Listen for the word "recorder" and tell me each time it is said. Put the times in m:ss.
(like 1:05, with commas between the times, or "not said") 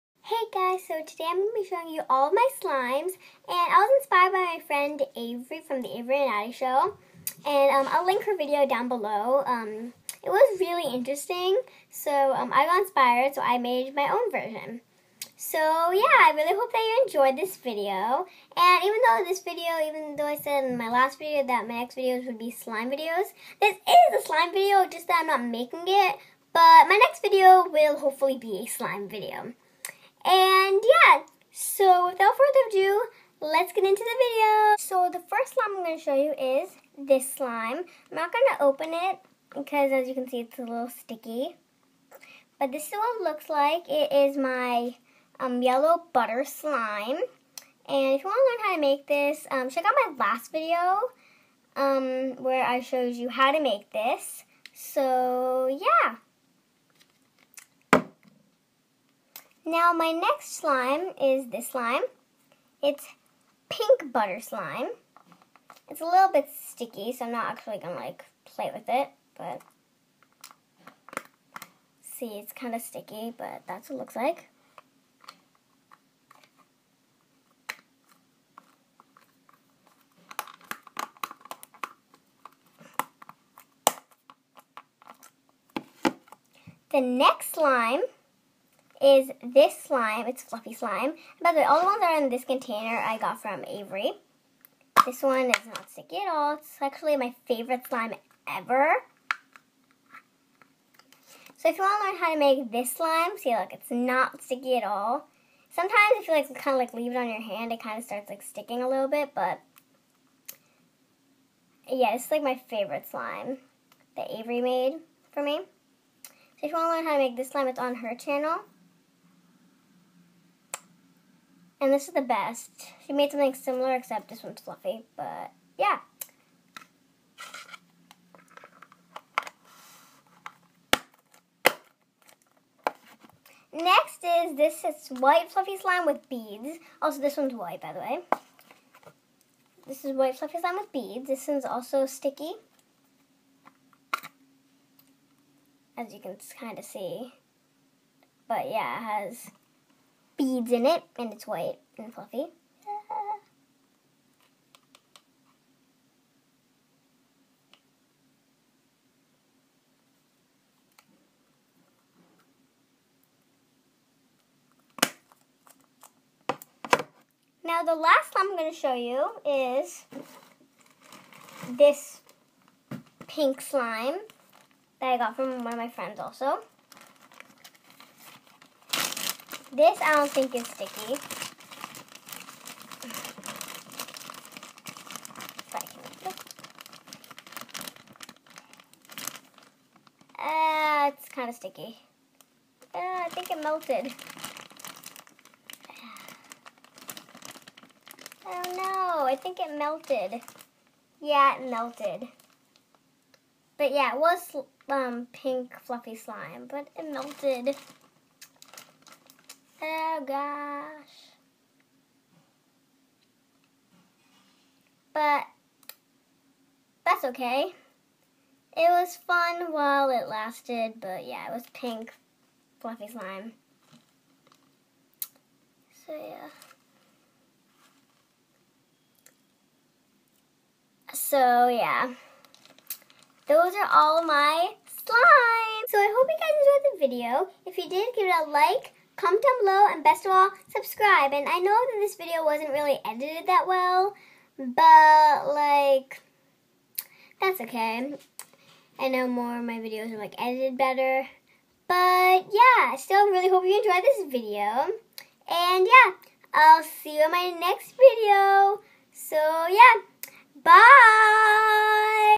not said.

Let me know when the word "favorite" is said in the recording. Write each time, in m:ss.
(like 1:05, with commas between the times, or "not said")
1:37, 1:52.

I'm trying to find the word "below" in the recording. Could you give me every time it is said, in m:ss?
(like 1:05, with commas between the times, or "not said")
0:08, 3:59.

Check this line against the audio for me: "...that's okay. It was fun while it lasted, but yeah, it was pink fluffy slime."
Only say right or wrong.
right.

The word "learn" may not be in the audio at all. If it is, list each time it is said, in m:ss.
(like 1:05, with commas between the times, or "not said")
0:48, 1:42, 1:56.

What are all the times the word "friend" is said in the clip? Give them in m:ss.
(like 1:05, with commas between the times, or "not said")
0:04, 2:55.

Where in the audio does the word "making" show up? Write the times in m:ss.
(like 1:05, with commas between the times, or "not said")
0:25.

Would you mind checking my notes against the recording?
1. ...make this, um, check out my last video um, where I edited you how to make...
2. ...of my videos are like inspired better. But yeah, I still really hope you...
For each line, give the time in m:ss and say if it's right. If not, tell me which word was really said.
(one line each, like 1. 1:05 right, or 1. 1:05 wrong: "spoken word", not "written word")
1. 0:48 wrong: "showed", not "edited"
2. 4:09 wrong: "edited", not "inspired".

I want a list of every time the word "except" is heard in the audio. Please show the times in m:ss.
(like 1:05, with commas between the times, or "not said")
2:03.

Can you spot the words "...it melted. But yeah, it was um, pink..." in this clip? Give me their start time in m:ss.
3:21.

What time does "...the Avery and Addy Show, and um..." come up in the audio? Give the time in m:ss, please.
0:05.